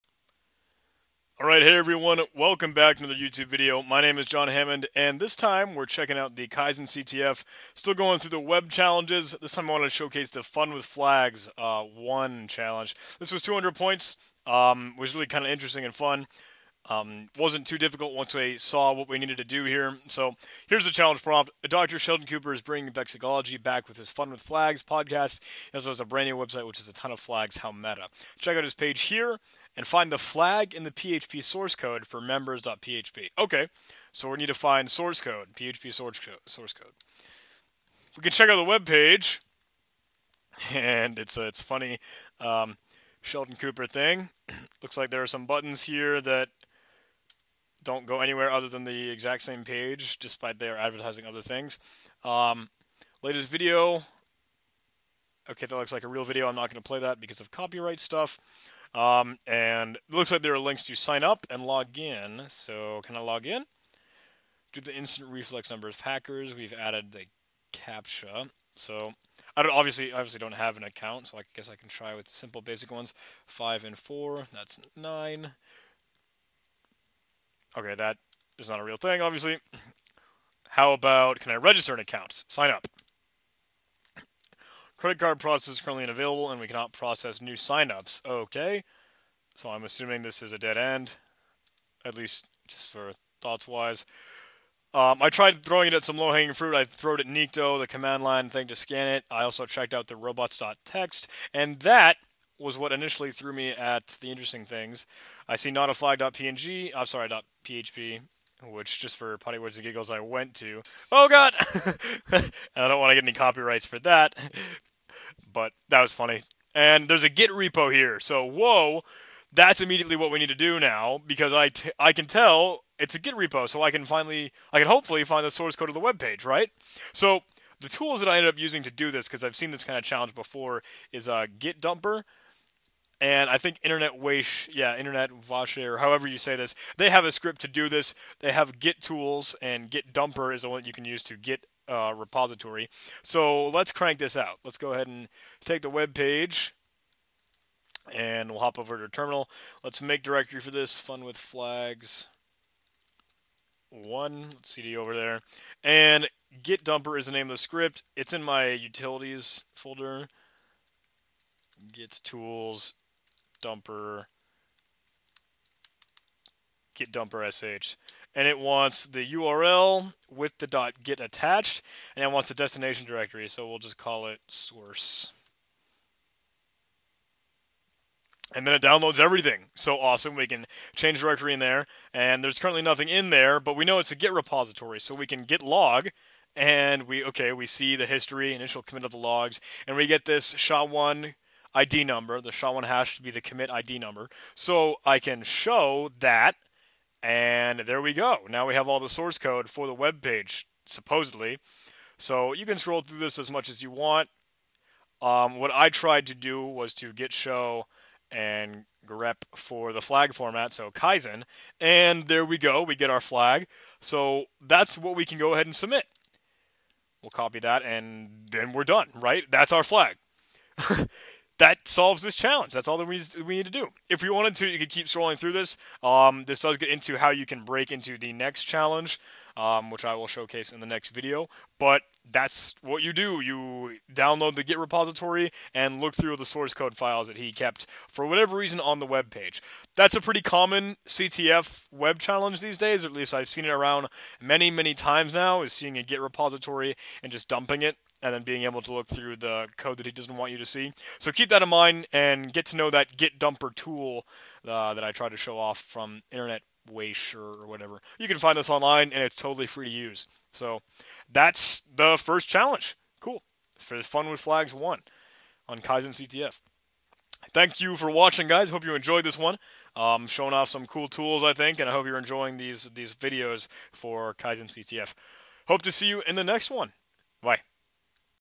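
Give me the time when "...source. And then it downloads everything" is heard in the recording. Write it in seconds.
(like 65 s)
174 s.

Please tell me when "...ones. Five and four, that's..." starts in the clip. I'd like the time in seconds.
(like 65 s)
72 s.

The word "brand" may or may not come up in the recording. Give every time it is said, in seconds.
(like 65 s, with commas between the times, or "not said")
26 s.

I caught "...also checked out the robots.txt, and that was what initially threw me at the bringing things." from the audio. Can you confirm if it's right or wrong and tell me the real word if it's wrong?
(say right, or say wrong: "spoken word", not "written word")
wrong: "interesting", not "bringing".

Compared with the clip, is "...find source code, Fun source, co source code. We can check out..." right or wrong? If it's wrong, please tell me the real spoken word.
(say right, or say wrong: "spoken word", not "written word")
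wrong: "PHP", not "Fun".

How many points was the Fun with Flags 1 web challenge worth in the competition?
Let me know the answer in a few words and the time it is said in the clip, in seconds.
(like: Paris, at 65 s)
200, at 13 s.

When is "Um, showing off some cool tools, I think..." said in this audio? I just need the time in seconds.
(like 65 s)
269 s.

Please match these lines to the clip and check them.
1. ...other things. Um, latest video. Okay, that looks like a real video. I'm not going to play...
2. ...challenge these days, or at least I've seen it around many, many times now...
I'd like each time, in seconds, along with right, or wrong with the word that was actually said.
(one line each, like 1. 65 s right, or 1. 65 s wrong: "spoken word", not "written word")
1. 51 s right
2. 242 s right.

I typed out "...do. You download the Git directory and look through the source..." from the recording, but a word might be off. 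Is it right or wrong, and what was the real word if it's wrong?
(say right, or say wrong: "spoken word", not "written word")
wrong: "repository", not "directory".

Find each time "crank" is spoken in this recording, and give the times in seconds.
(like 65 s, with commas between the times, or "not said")
143 s.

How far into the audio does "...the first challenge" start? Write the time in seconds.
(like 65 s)
261 s.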